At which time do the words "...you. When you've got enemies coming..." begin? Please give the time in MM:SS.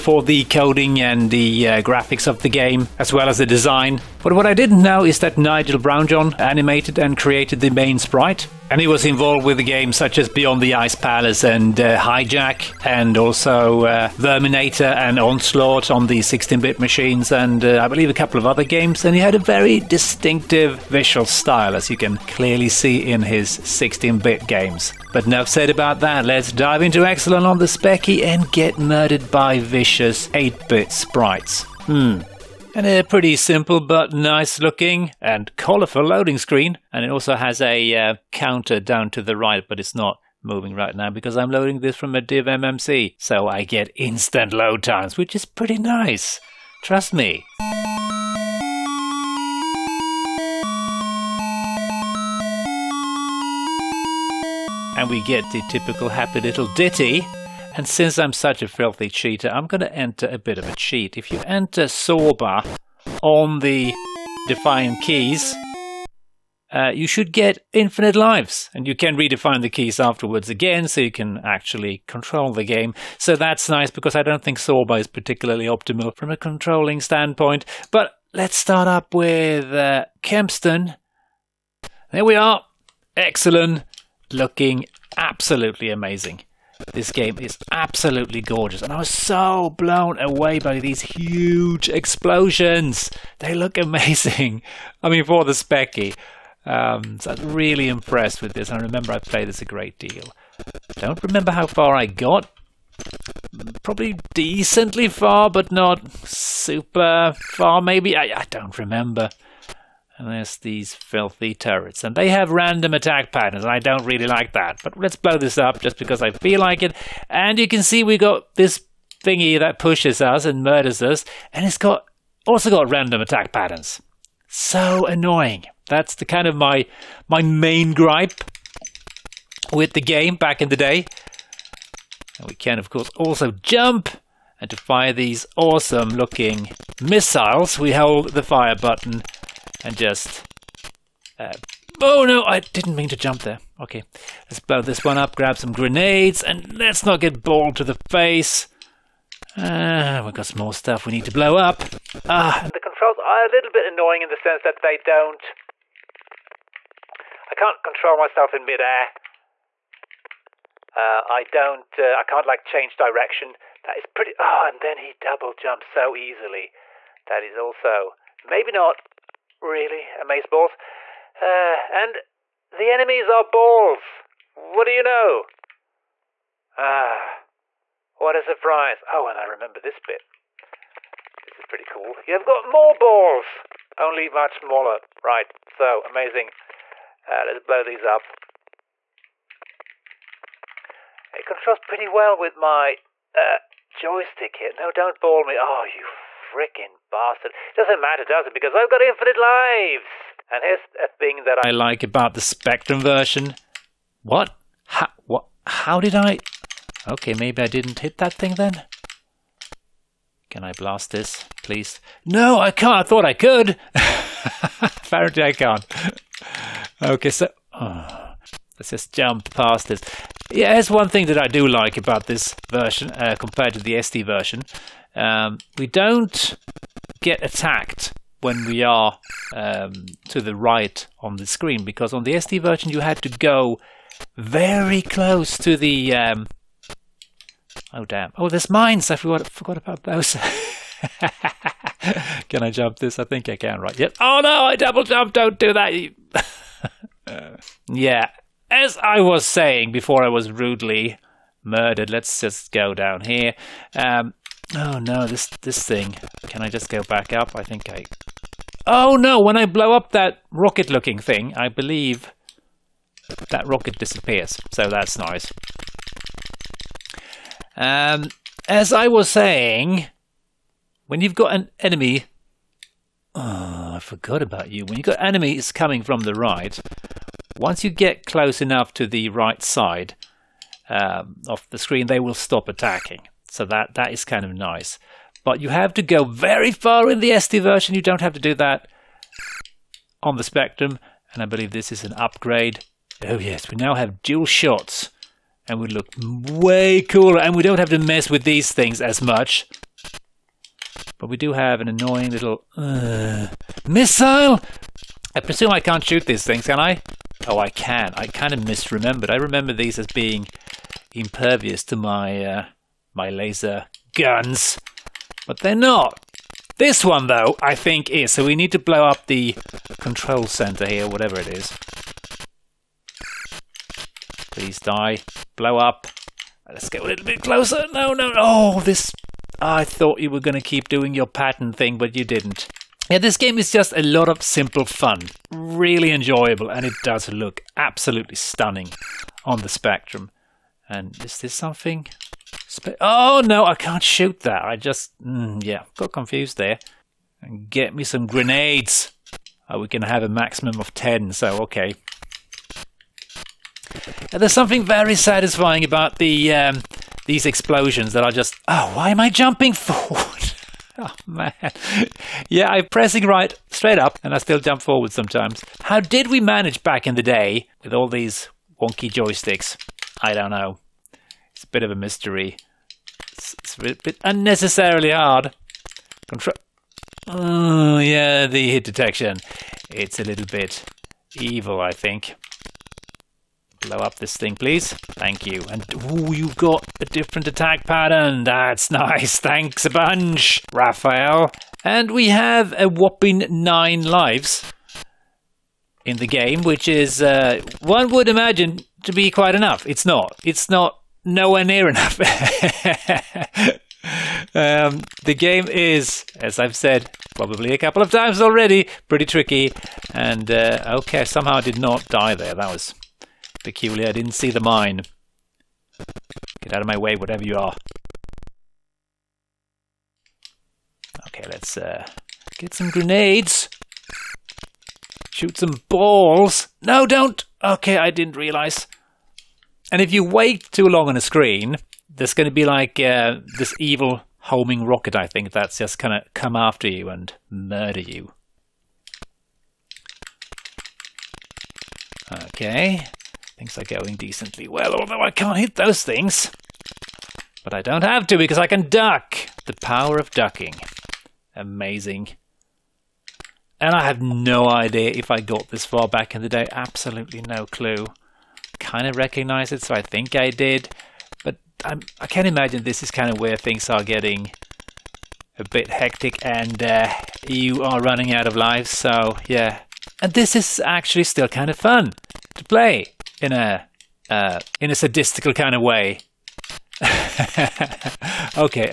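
04:34.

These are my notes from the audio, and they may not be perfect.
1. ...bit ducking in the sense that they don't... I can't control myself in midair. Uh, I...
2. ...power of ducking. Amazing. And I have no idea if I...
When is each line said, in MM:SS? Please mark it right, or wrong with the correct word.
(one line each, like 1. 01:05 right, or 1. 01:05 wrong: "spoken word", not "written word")
1. 02:33 wrong: "annoying", not "ducking"
2. 07:29 right.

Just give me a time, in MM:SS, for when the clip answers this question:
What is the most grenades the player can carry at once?
05:50.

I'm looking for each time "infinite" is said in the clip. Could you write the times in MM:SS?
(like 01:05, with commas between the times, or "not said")
01:07, 03:19.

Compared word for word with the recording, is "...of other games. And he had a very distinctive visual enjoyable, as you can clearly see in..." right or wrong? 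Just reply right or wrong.
wrong.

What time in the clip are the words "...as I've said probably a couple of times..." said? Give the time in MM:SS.
06:46.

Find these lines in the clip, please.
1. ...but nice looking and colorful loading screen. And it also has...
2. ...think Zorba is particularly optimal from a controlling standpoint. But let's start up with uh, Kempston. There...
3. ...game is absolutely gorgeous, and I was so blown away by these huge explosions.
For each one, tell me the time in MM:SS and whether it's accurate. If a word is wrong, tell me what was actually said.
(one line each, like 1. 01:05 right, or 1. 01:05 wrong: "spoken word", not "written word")
1. 00:33 right
2. 01:14 right
3. 01:27 right.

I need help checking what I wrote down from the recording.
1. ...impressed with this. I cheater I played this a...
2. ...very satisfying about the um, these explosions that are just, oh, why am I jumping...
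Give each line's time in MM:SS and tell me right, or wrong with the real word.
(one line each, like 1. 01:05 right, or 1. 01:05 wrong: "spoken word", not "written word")
1. 01:37 wrong: "remember", not "cheater"
2. 05:54 right.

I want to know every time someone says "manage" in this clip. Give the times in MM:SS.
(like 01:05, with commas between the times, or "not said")
06:06.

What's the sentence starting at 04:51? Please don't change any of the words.
And I believe this is an upgrade.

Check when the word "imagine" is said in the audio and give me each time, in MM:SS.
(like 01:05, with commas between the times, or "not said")
06:38, 07:42.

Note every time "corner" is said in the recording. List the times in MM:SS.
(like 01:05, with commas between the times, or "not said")
not said.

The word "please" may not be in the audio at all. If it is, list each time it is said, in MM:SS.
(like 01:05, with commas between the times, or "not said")
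03:31, 05:24, 06:24.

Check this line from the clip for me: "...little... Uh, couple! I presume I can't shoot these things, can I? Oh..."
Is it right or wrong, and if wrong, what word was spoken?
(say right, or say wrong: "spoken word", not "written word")
wrong: "missile", not "couple".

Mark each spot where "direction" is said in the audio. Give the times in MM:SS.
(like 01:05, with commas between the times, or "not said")
02:42.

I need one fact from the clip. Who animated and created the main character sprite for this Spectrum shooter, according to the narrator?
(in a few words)
Nigel Brownjohn.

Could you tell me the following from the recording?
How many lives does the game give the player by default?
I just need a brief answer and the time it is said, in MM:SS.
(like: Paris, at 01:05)
9, at 06:33.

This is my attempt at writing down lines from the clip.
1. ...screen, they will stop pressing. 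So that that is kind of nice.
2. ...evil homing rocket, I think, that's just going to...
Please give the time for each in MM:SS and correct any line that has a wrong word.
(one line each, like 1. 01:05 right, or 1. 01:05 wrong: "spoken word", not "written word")
1. 04:41 wrong: "attacking", not "pressing"
2. 07:13 right.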